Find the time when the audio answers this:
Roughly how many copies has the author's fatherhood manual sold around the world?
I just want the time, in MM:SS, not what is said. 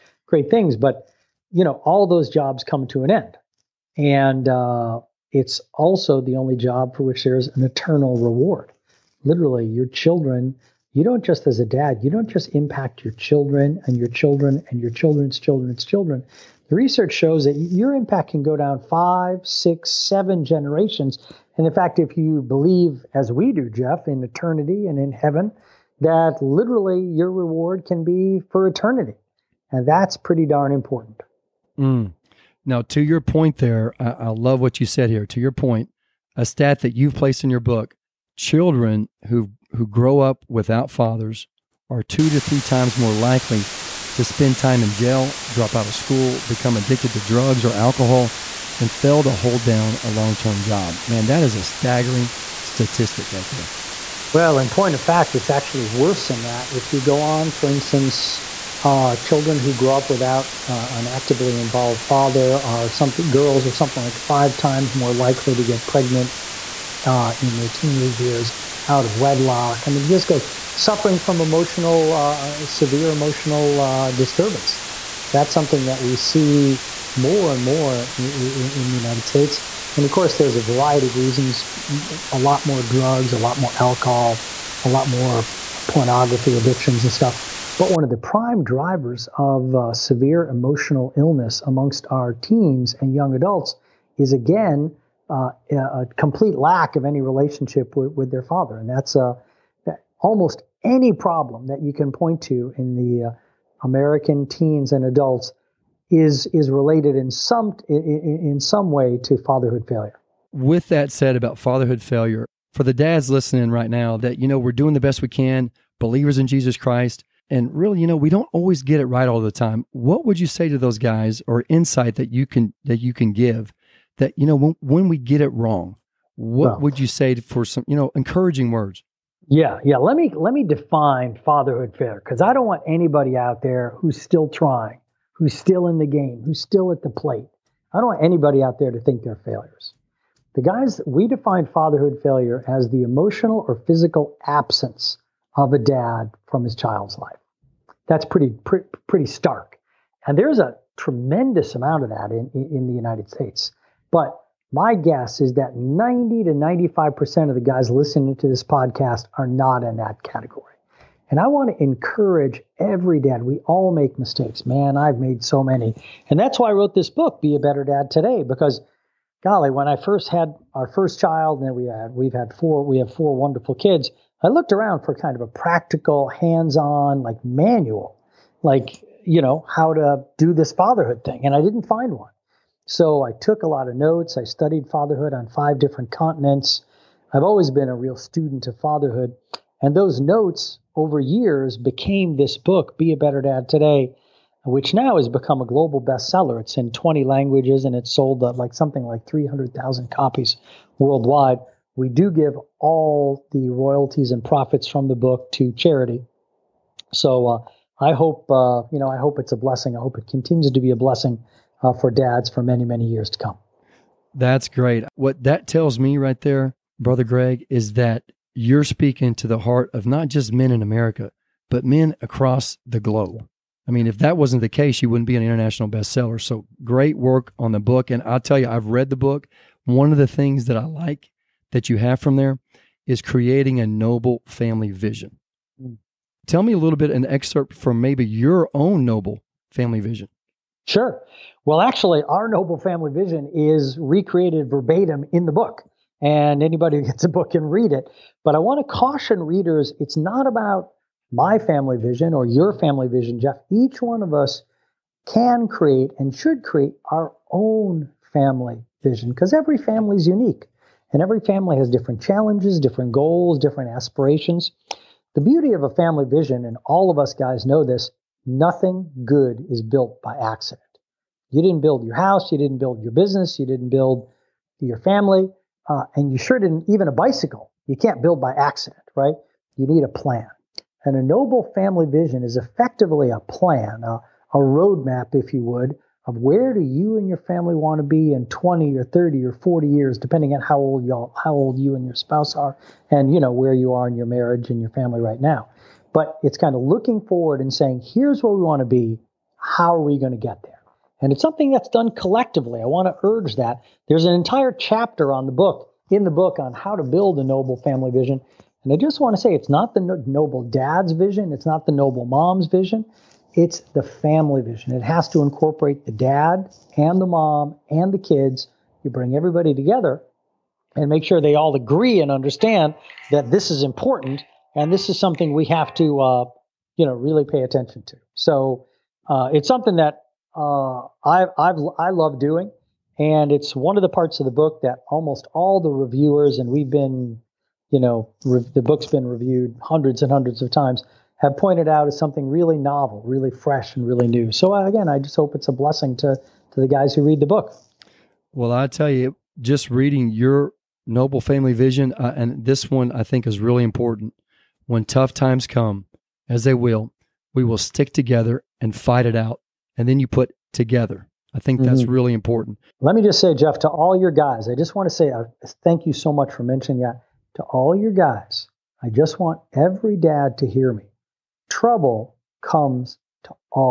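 03:19.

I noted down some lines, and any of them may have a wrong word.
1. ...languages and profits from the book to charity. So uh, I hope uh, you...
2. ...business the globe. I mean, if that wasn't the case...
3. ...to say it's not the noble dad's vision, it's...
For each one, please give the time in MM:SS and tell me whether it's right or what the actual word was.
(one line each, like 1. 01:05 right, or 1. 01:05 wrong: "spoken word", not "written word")
1. 03:23 wrong: "royalties", not "languages"
2. 03:42 wrong: "across", not "business"
3. 05:09 right.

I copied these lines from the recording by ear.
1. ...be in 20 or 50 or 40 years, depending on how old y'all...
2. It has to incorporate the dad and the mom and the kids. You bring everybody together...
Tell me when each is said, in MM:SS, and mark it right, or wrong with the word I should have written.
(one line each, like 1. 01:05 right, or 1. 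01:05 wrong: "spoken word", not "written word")
1. 04:48 wrong: "30", not "50"
2. 05:14 right.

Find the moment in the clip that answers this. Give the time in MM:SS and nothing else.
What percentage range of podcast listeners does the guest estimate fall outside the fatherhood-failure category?
02:35.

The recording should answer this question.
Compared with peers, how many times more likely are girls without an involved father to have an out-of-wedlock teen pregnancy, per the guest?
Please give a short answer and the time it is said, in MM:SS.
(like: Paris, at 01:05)
5, at 01:04.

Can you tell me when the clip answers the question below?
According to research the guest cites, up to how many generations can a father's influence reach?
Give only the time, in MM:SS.
00:19.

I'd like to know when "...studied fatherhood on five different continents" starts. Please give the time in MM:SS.
03:04.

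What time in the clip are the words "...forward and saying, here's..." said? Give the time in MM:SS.
04:57.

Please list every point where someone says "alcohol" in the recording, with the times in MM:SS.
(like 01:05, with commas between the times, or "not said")
00:47, 01:23.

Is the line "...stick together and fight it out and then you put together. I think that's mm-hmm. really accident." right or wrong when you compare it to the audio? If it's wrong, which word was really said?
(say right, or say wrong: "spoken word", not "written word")
wrong: "important", not "accident".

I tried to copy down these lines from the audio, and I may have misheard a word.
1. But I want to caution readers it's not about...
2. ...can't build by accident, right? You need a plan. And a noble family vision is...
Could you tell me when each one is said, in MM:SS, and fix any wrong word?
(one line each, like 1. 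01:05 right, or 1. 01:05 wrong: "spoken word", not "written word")
1. 04:08 right
2. 04:37 right.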